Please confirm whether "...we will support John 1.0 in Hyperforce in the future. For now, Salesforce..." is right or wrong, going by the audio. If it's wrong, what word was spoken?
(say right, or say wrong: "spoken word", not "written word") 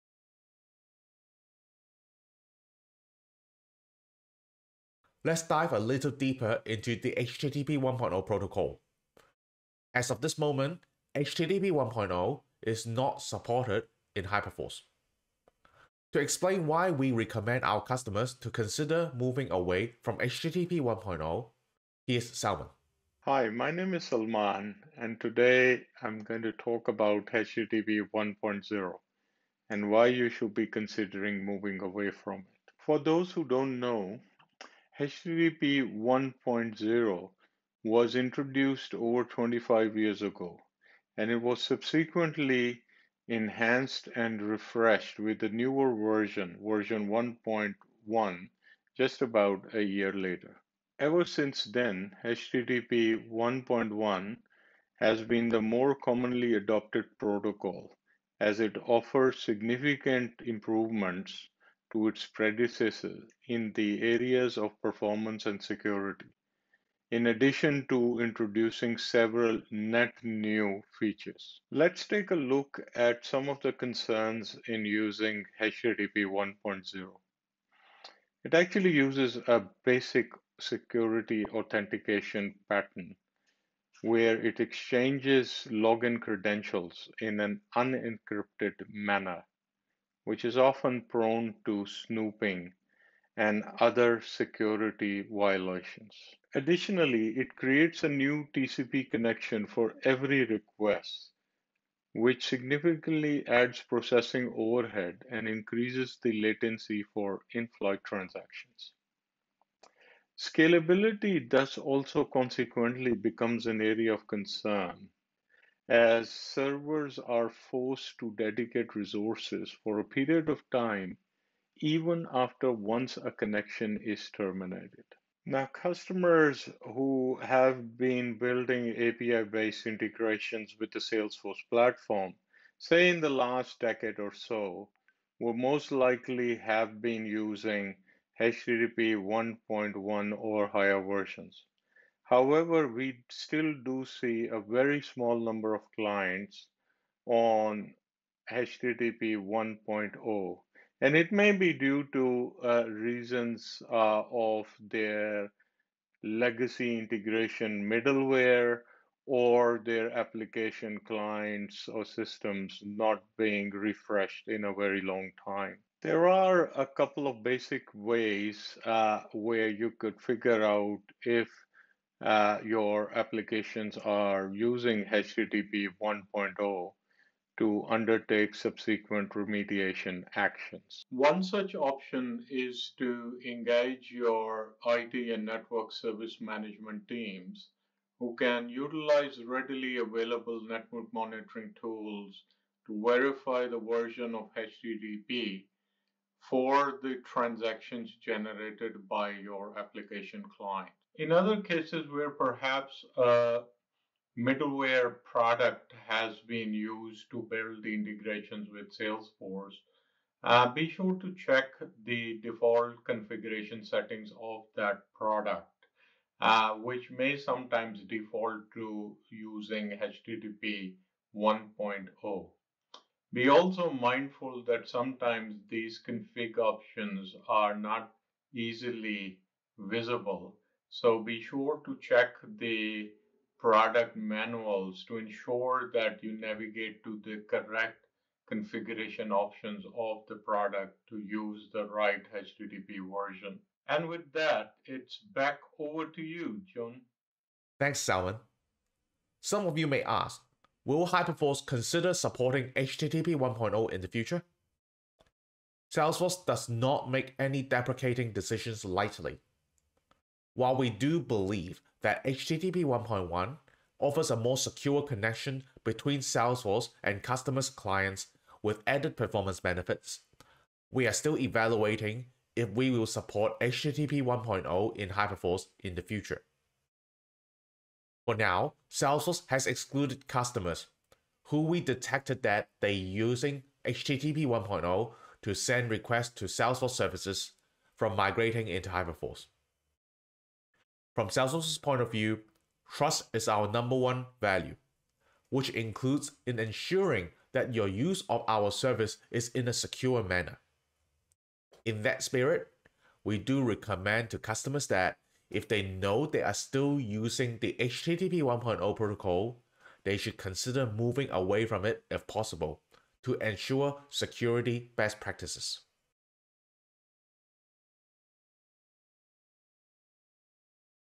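wrong: "HTTP", not "John".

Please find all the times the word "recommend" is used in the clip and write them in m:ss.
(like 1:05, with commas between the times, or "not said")
0:17, 5:03.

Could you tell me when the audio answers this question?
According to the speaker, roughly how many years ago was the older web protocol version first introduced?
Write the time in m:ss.
0:38.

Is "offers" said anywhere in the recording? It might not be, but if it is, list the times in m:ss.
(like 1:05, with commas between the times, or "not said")
0:58, 4:23.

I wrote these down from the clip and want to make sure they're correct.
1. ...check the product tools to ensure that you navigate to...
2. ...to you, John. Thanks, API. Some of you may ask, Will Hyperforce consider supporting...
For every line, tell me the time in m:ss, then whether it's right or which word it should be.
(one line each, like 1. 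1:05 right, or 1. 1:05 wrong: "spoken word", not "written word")
1. 3:52 wrong: "manuals", not "tools"
2. 4:06 wrong: "Salman", not "API".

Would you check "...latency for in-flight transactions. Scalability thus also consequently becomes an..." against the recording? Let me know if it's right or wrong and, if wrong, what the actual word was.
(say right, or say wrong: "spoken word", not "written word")
right.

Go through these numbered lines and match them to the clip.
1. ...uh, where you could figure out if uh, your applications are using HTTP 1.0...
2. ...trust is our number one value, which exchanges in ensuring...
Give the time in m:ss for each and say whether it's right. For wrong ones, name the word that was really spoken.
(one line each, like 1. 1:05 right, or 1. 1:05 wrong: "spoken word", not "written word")
1. 2:48 right
2. 4:52 wrong: "includes", not "exchanges".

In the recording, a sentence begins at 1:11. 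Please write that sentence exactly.
Let's take a look at some of the concerns in using HTTP 1.0.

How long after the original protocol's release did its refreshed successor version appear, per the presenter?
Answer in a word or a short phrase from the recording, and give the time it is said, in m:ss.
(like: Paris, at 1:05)
about a year later, at 0:48.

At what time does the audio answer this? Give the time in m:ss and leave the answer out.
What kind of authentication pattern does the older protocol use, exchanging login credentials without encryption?
1:19.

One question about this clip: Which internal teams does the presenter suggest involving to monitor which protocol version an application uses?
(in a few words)
IT and network service management.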